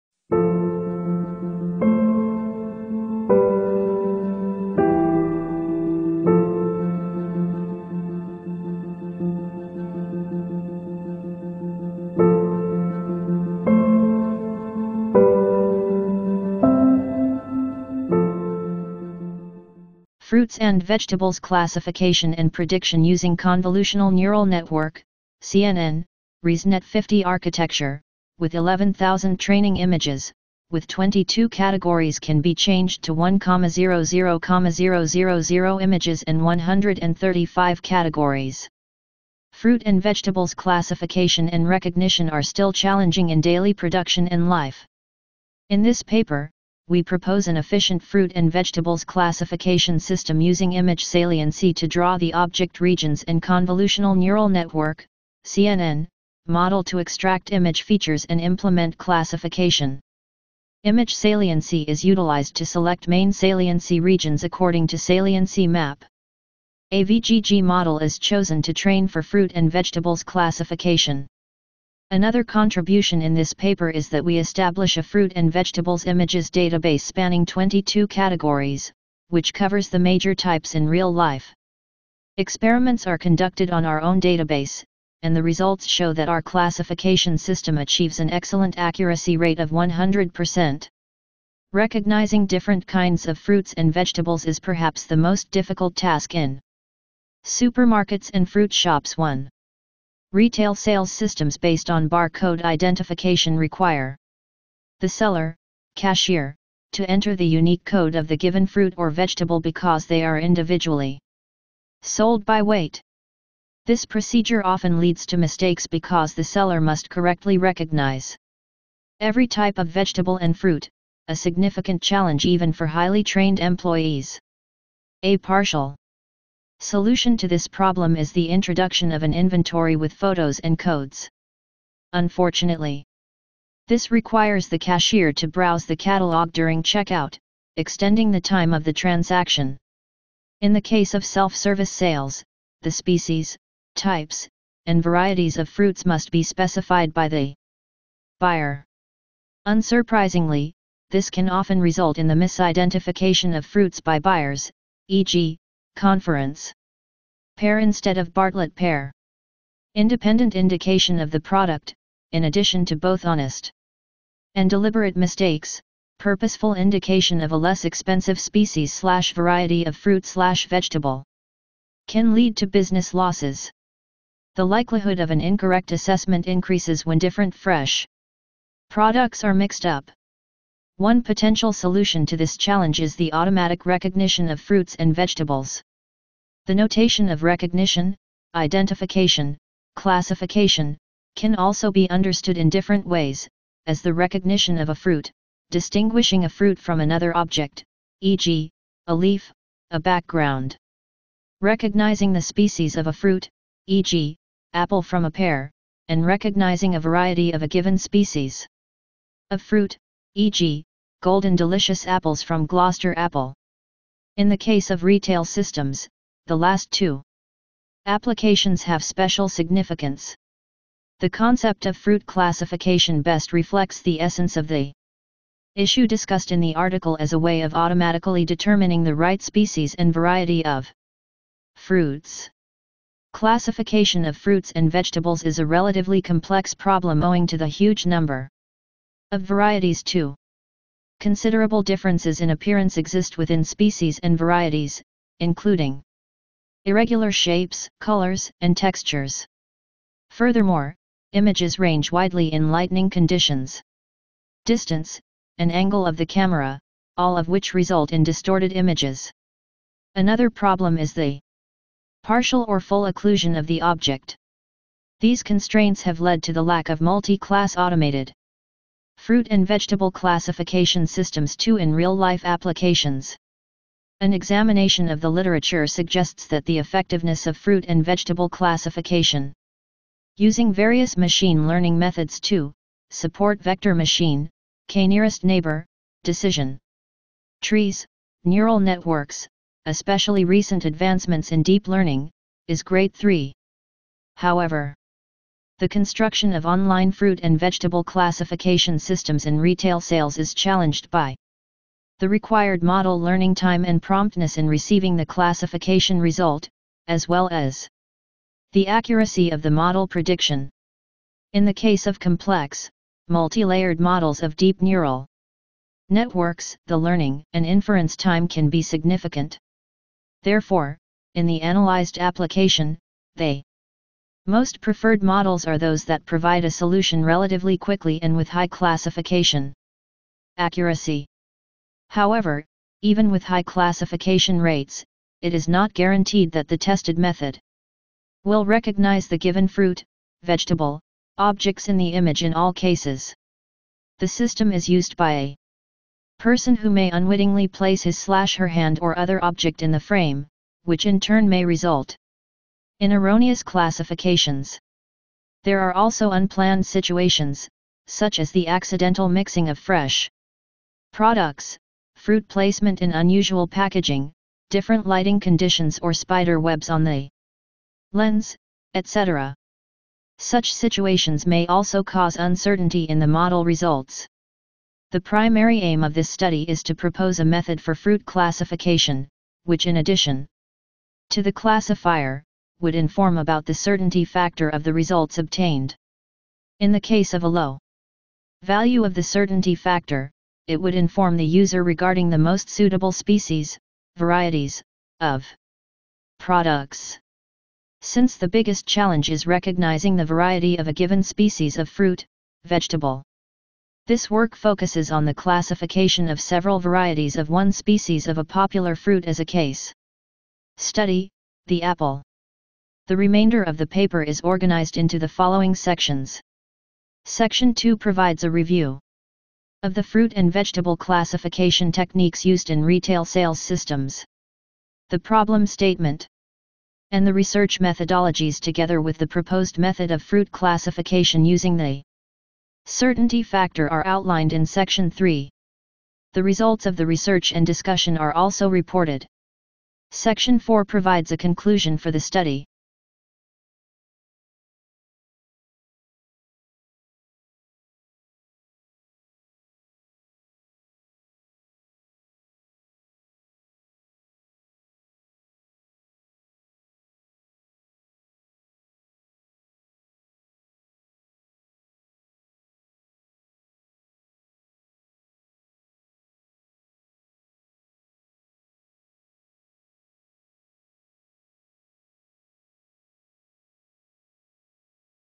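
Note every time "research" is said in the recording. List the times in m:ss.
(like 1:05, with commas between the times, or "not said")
7:07, 7:17.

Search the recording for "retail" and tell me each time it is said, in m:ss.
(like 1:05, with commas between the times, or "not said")
1:40, 3:35, 4:59, 7:02.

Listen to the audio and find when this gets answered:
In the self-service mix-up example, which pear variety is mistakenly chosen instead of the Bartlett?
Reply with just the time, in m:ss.
2:35.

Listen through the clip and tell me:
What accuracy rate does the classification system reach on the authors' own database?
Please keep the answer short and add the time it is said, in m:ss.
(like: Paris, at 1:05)
100%, at 1:29.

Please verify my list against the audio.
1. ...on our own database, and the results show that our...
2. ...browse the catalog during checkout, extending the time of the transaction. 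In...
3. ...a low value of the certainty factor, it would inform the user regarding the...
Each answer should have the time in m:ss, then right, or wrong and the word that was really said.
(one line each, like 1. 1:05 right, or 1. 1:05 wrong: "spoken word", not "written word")
1. 1:23 right
2. 2:15 right
3. 6:27 right.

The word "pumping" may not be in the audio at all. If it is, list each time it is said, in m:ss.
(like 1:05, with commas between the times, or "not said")
not said.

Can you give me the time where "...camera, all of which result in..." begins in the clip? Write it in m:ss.
4:16.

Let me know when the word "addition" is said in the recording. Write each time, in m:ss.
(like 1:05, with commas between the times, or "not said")
2:42, 6:19.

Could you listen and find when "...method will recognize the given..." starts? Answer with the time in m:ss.
5:37.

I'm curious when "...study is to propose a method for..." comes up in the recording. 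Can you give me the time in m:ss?
6:16.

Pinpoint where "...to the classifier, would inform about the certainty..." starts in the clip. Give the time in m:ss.
6:21.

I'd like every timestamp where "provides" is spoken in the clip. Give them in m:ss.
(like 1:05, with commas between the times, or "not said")
5:26, 6:57, 7:20.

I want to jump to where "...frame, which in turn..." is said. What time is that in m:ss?
5:49.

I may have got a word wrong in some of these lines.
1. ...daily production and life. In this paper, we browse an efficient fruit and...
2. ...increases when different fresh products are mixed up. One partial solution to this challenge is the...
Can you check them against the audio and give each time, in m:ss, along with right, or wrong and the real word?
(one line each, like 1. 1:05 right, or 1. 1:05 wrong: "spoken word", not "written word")
1. 0:43 wrong: "propose", not "browse"
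2. 2:56 wrong: "potential", not "partial".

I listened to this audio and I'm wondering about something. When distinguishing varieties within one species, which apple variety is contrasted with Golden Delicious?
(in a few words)
Gloster.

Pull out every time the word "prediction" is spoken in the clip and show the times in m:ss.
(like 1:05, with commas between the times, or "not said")
0:22, 5:10.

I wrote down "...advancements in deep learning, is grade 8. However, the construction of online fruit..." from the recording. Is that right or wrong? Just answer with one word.
wrong.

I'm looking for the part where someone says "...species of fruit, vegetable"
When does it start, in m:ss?
6:41.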